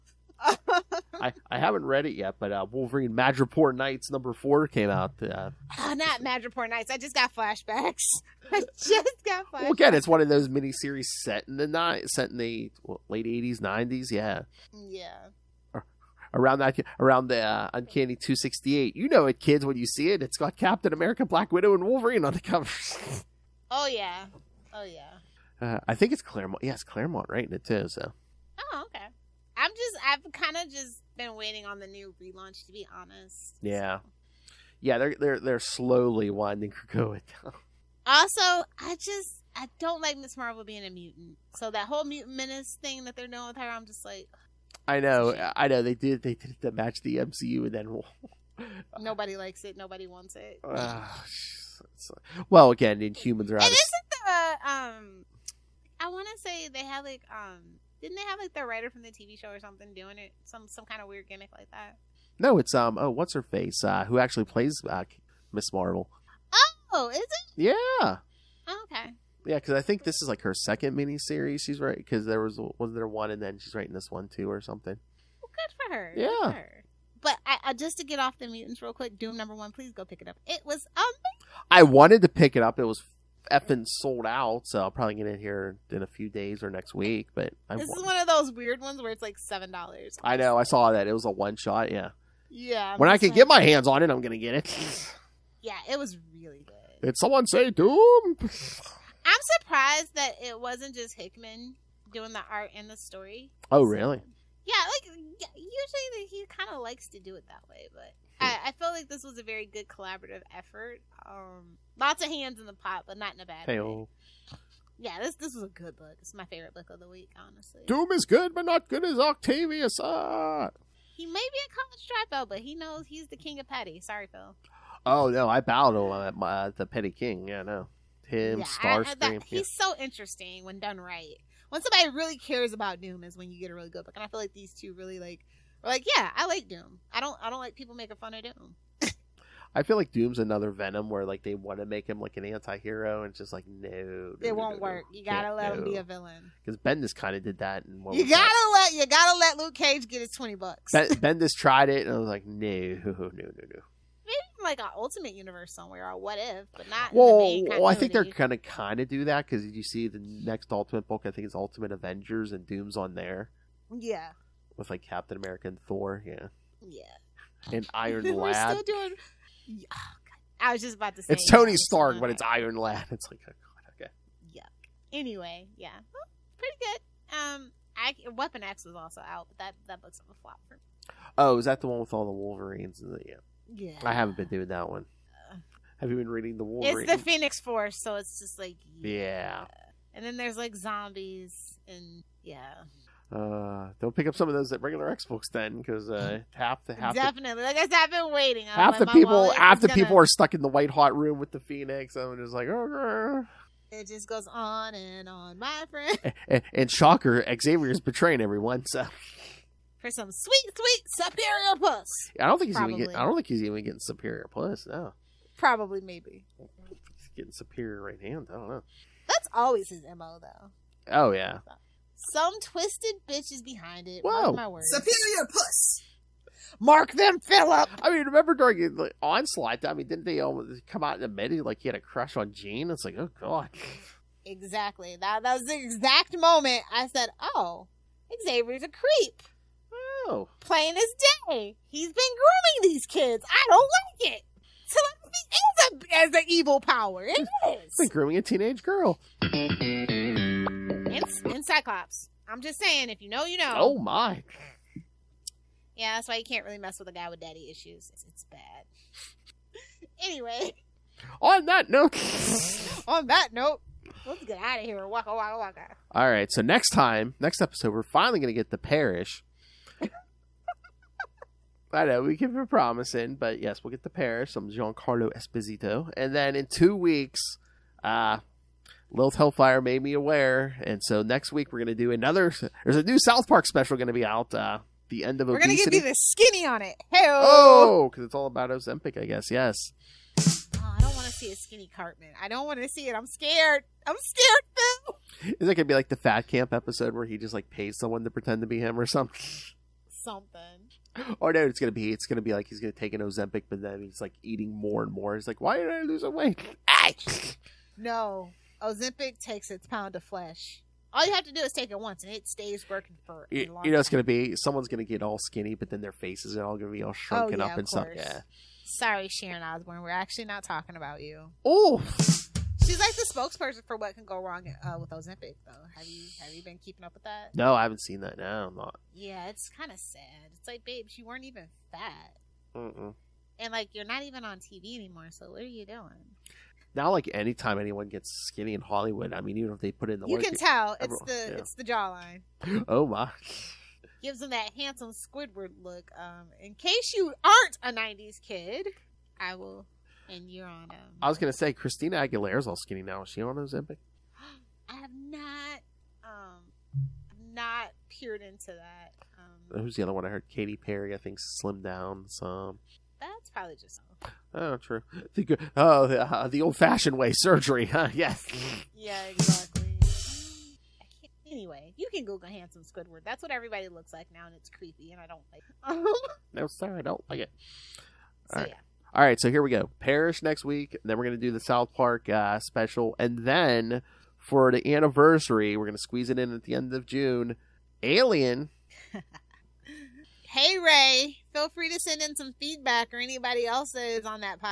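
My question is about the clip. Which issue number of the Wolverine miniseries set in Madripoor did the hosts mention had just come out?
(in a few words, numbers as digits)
4.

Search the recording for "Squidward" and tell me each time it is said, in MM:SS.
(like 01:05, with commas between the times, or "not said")
05:45, 06:12.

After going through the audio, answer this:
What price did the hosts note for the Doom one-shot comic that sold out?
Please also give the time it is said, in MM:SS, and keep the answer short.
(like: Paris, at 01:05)
$7, at 01:29.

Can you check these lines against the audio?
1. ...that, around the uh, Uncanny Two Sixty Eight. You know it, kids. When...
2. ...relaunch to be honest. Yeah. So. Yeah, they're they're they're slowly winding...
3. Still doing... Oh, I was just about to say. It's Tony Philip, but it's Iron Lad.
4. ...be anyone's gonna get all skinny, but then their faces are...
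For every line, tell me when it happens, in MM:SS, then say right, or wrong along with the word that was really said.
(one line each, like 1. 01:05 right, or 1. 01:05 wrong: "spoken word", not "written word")
1. 00:16 right
2. 00:32 right
3. 02:48 wrong: "Stark", not "Philip"
4. 05:14 wrong: "someone", not "anyone".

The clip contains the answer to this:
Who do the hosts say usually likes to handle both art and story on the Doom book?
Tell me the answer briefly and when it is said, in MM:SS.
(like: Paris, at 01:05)
Hickman, at 01:41.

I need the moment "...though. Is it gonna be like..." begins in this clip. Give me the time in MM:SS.
04:54.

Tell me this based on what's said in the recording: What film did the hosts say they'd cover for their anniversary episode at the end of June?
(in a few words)
Alien.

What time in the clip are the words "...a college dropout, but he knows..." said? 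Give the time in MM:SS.
02:01.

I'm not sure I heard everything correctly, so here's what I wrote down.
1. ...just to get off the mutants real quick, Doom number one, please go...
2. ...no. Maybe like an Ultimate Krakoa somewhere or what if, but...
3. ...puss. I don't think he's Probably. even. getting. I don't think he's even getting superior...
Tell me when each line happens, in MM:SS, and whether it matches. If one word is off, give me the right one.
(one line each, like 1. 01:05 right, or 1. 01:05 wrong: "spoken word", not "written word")
1. 01:17 right
2. 02:33 wrong: "Universe", not "Krakoa"
3. 03:31 right.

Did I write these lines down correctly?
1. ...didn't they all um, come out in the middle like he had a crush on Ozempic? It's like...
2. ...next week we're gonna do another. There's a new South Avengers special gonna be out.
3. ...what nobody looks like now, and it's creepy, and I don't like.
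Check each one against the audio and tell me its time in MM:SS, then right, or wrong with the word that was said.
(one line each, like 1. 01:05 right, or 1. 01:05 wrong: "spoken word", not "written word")
1. 03:50 wrong: "Jean", not "Ozempic"
2. 04:41 wrong: "Park", not "Avengers"
3. 06:13 wrong: "everybody", not "nobody".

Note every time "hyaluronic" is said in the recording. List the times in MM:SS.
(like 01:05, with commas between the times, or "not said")
not said.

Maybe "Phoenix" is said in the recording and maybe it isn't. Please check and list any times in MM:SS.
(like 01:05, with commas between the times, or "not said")
03:07, 03:21.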